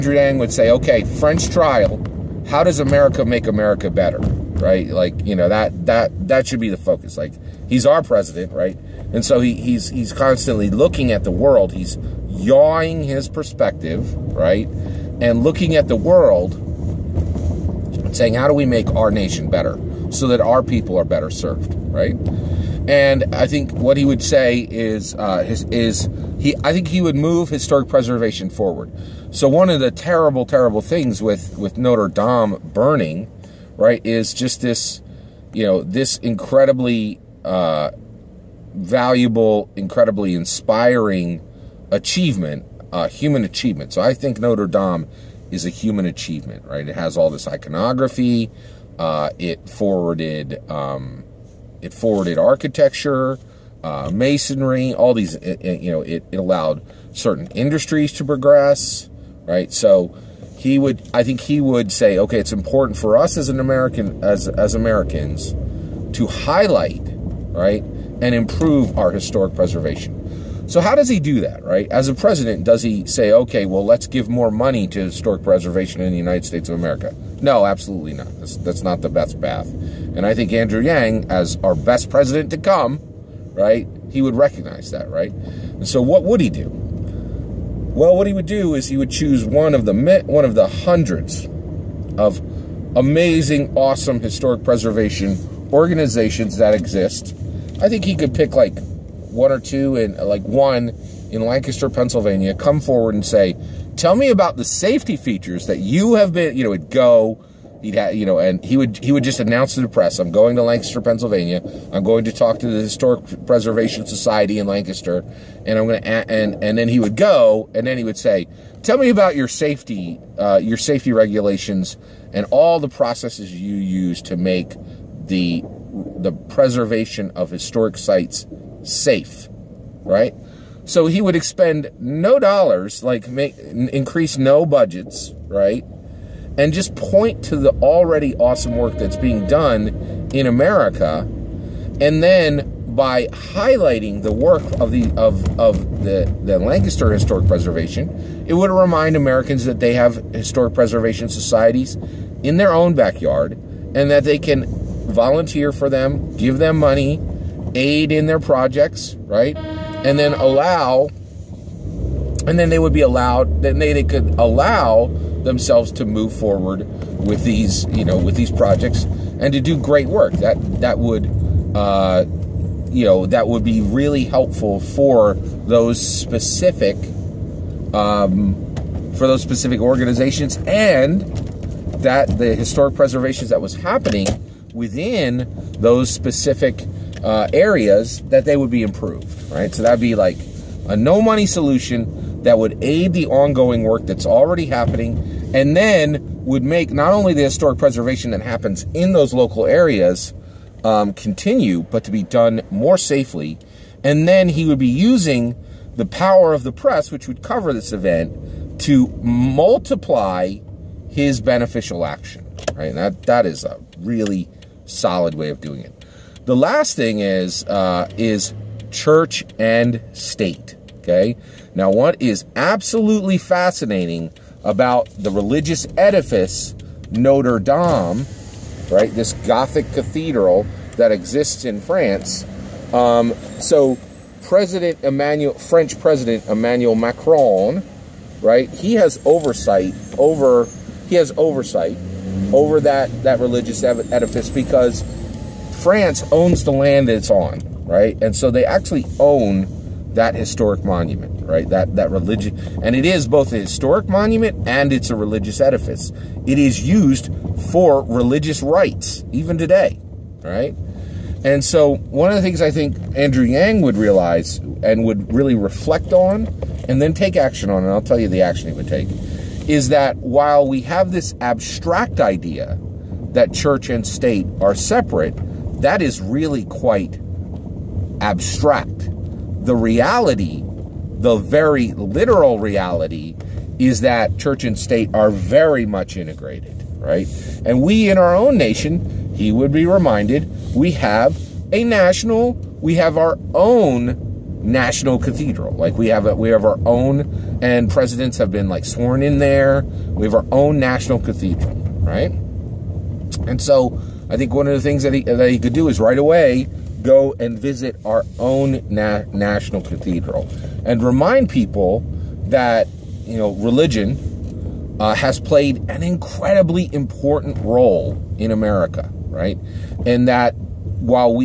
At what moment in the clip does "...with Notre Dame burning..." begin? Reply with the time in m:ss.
0:31.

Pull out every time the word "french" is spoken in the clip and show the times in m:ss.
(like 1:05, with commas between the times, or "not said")
0:01, 3:55.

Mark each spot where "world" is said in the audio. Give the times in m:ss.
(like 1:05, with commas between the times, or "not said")
0:11, 0:15.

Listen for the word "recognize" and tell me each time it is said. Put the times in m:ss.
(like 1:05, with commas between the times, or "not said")
1:24.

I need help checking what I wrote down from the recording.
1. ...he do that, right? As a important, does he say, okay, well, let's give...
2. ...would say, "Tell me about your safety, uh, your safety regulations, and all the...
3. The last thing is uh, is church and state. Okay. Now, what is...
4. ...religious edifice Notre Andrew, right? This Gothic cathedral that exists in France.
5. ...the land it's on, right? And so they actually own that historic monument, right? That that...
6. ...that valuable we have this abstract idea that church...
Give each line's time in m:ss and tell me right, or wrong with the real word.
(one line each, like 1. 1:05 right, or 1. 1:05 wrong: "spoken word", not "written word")
1. 1:11 wrong: "president", not "important"
2. 1:58 right
3. 3:36 right
4. 3:45 wrong: "Dame", not "Andrew"
5. 4:06 right
6. 4:29 wrong: "while", not "valuable".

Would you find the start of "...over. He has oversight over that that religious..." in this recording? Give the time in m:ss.
4:00.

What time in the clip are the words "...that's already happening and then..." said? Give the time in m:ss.
3:14.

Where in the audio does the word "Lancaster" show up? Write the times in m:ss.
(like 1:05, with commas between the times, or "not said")
1:41, 1:50, 1:54, 2:26.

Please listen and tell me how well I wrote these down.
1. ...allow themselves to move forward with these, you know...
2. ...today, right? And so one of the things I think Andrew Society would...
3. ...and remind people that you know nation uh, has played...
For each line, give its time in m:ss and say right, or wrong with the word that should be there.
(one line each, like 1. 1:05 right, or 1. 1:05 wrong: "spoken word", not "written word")
1. 2:44 right
2. 4:19 wrong: "Yang", not "Society"
3. 5:10 wrong: "religion", not "nation".